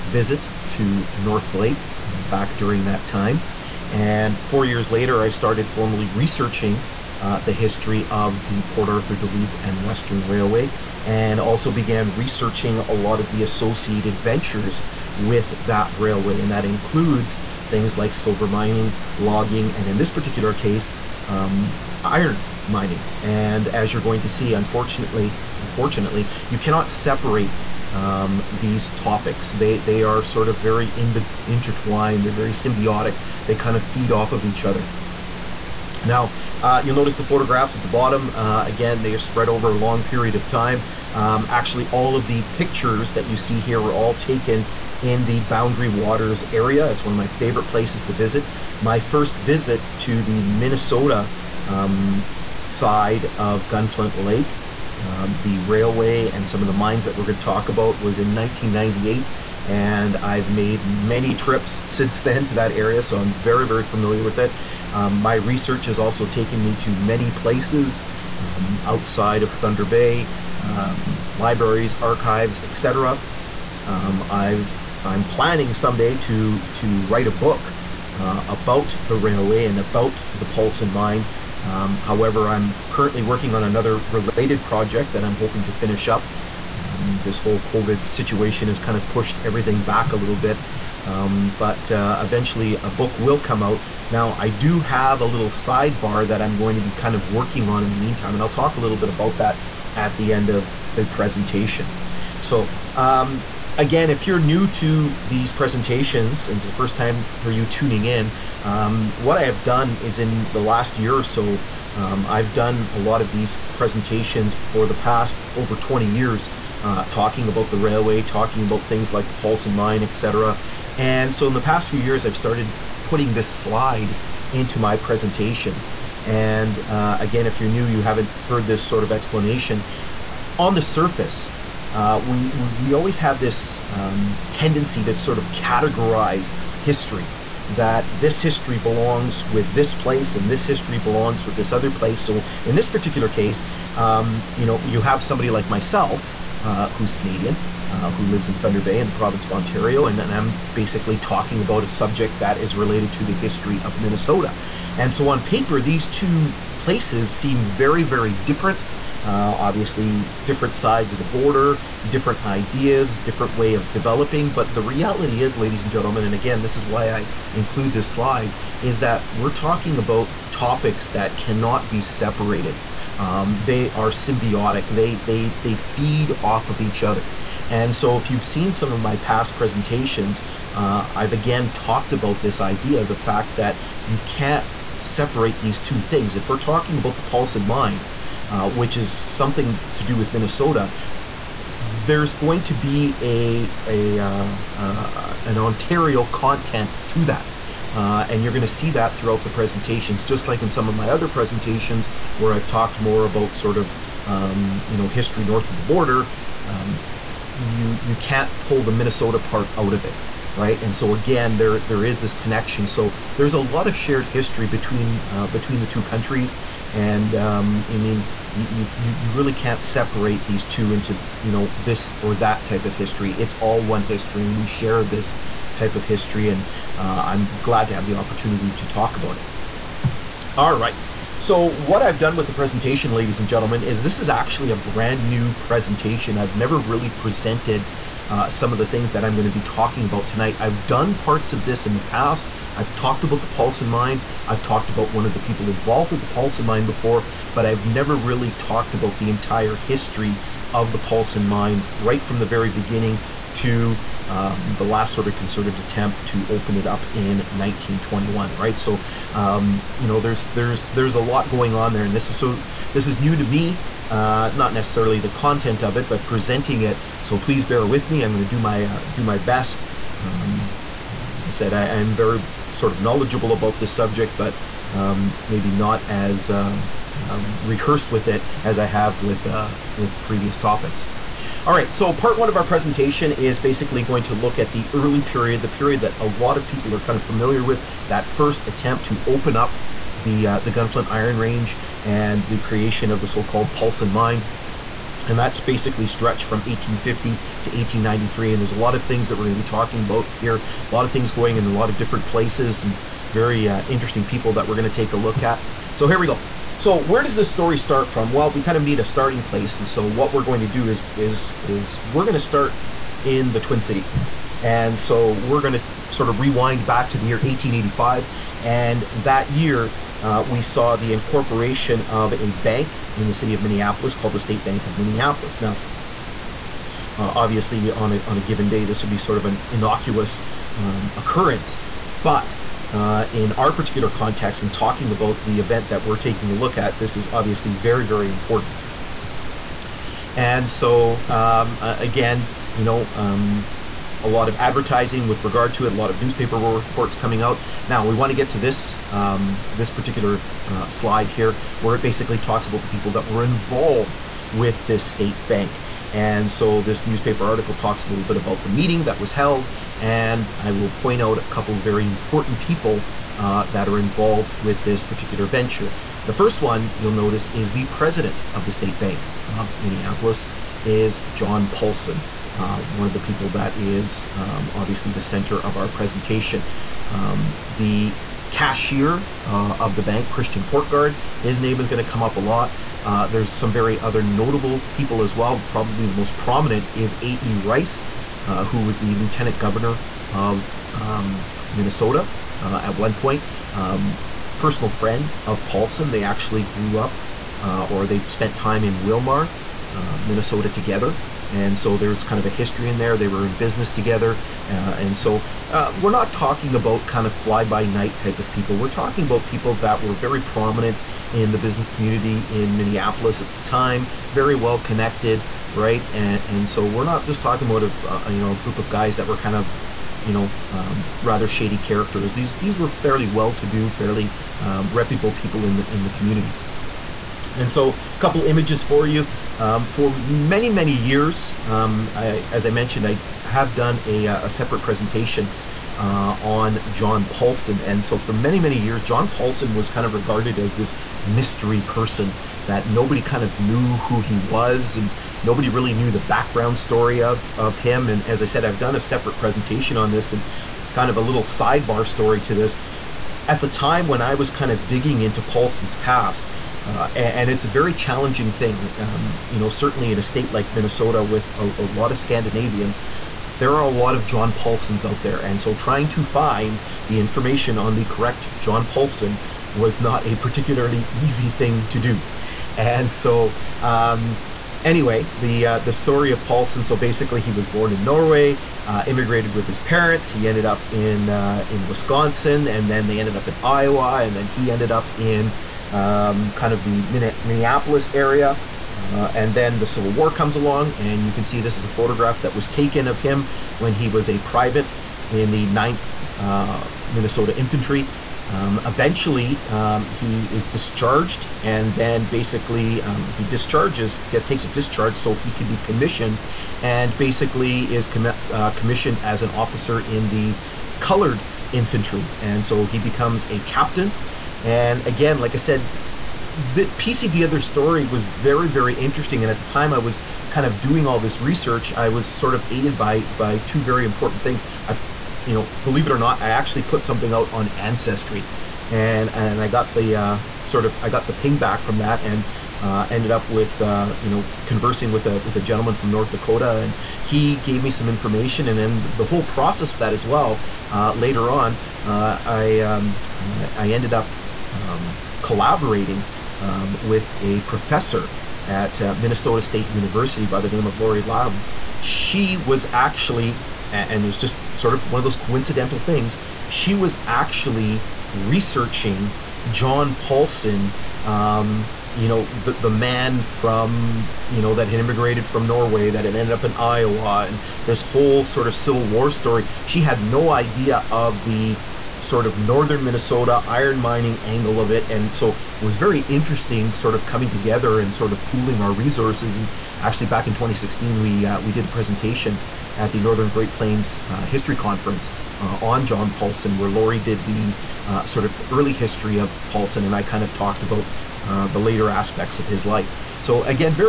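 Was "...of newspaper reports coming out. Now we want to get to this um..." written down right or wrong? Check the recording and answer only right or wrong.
right.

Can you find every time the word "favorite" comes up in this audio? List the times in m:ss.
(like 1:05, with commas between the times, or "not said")
0:47.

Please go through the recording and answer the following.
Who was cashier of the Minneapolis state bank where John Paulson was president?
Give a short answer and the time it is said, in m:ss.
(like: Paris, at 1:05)
Christian Courtguard, at 6:20.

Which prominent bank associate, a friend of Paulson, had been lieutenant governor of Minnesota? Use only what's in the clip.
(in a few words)
A.E. Rice.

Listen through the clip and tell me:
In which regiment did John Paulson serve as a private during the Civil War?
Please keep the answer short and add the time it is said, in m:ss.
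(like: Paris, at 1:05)
9th Minnesota Infantry, at 8:15.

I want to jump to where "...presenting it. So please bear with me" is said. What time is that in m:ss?
4:26.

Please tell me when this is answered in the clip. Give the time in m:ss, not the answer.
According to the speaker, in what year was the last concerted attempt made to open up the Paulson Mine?
4:17.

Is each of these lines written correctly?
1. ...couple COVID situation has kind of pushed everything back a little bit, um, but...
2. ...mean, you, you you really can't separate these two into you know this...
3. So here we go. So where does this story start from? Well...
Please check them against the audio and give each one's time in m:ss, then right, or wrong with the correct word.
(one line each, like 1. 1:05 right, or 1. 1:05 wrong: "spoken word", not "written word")
1. 1:27 wrong: "whole", not "couple"
2. 3:37 right
3. 5:05 right.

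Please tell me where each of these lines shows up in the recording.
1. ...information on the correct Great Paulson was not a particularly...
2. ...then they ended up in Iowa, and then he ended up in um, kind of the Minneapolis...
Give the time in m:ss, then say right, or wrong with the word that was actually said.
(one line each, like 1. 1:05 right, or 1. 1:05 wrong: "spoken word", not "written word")
1. 7:47 wrong: "John", not "Great"
2. 8:02 right.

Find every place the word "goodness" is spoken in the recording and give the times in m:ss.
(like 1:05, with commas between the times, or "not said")
not said.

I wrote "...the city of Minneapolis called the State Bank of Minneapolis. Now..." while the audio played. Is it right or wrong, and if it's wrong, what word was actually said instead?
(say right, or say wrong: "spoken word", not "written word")
right.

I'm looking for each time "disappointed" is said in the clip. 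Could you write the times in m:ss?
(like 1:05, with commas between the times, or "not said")
not said.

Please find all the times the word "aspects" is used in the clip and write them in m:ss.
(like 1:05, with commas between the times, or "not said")
9:52.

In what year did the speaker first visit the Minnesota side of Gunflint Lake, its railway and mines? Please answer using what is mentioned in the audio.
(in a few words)
1998.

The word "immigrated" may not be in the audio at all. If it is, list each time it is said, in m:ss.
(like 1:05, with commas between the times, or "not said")
7:59, 9:24.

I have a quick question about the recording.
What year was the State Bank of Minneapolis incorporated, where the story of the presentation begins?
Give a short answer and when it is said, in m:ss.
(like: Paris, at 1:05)
1885, at 5:17.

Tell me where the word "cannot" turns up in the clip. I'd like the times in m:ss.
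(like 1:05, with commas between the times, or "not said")
0:26, 2:51.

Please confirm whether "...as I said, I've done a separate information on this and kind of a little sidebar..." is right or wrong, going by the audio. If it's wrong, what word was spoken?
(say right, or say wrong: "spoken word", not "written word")
wrong: "presentation", not "information".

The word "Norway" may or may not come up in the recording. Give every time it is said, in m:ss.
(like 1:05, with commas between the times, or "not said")
7:58, 9:25.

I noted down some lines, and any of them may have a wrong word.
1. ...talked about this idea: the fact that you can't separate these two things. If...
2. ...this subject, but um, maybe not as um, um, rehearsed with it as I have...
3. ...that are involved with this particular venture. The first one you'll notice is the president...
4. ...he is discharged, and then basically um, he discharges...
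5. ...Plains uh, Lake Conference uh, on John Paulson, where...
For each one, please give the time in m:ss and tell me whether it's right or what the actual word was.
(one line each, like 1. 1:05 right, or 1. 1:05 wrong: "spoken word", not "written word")
1. 3:01 right
2. 4:33 right
3. 6:03 right
4. 8:20 right
5. 9:43 wrong: "History", not "Lake".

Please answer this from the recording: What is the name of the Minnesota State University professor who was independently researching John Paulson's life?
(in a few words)
Lori Lam.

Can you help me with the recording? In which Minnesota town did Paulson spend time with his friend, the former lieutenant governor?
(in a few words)
Willmar.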